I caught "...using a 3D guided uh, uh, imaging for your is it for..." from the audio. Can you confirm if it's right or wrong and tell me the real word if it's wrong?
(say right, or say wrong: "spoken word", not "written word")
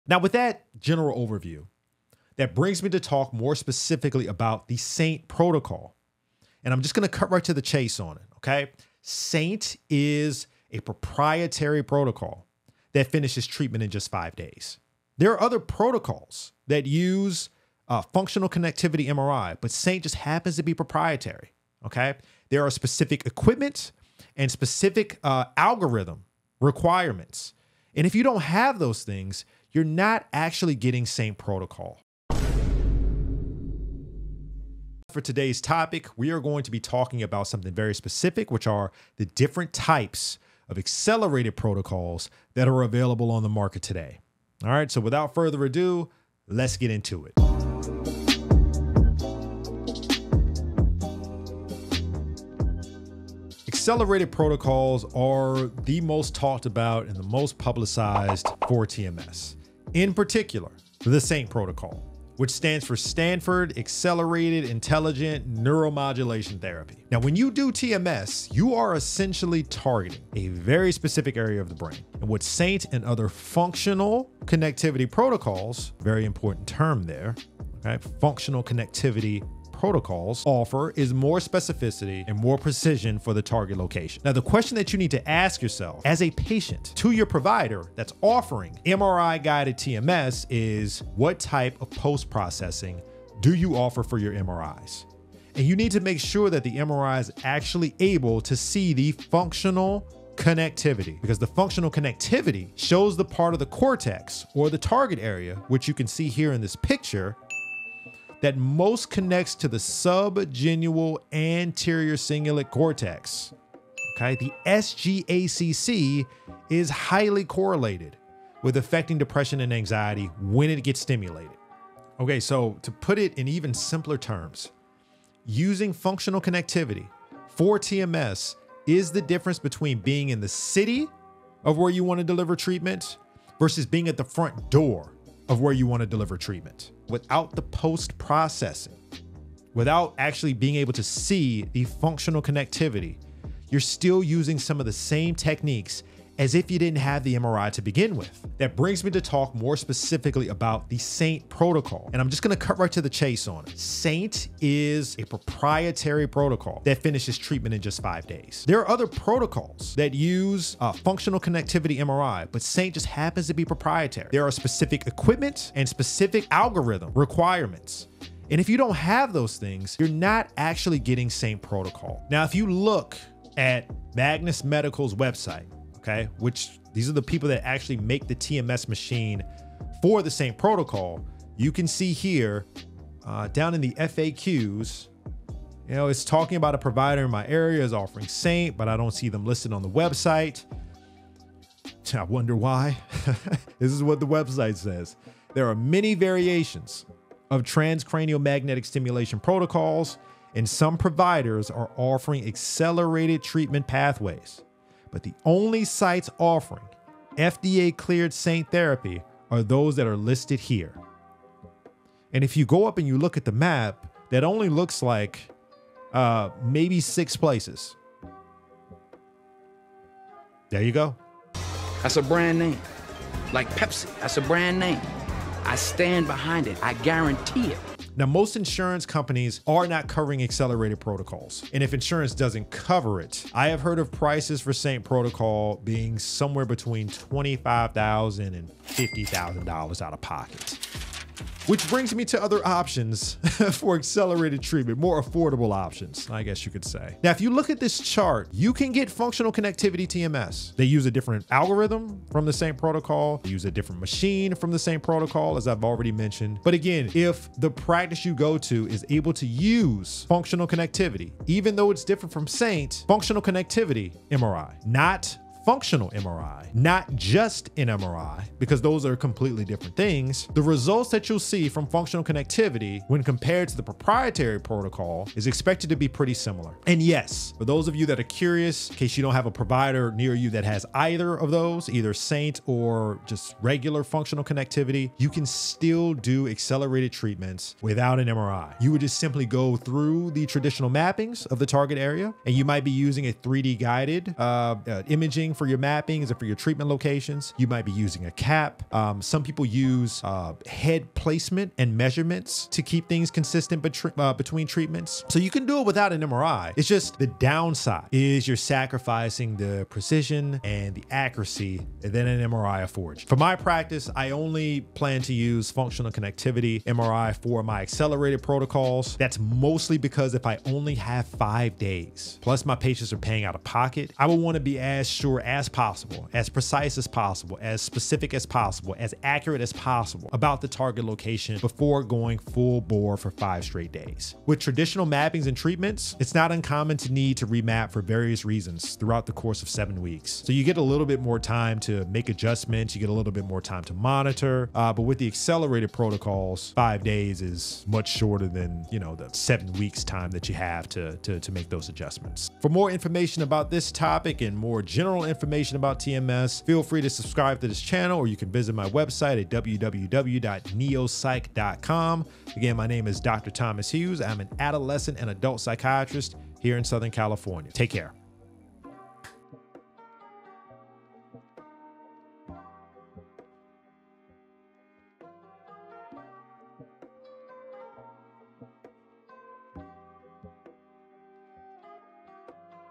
right.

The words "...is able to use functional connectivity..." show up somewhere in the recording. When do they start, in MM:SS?
04:18.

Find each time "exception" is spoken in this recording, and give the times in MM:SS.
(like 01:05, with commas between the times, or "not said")
not said.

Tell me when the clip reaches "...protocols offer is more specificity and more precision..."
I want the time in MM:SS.
01:19.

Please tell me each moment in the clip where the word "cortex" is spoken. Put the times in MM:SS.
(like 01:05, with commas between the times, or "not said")
01:43, 01:52.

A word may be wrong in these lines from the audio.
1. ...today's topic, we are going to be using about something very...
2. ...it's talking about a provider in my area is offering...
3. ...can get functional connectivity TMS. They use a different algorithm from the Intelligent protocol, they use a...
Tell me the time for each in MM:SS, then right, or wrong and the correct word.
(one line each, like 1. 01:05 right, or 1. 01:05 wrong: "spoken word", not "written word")
1. 00:35 wrong: "talking", not "using"
2. 03:06 right
3. 04:08 wrong: "SAINT", not "Intelligent".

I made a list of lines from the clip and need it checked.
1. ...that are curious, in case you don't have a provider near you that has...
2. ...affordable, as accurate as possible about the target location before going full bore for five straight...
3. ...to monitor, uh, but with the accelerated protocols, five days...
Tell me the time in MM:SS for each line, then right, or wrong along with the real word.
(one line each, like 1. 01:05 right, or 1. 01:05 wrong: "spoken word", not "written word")
1. 04:38 right
2. 05:28 wrong: "possible", not "affordable"
3. 05:43 right.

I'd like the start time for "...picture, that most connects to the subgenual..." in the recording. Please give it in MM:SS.
01:46.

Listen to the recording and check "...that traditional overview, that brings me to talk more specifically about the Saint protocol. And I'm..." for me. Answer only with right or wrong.
wrong.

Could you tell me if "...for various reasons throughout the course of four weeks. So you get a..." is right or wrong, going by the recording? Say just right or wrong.
wrong.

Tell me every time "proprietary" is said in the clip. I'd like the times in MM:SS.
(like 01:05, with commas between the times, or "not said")
00:10, 00:20, 02:35, 02:43, 04:33.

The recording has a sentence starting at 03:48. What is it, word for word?
Now, most insurance companies are not covering accelerated protocols.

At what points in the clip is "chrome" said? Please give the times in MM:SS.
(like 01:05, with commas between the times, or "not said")
not said.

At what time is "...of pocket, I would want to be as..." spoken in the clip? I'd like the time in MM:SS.
05:23.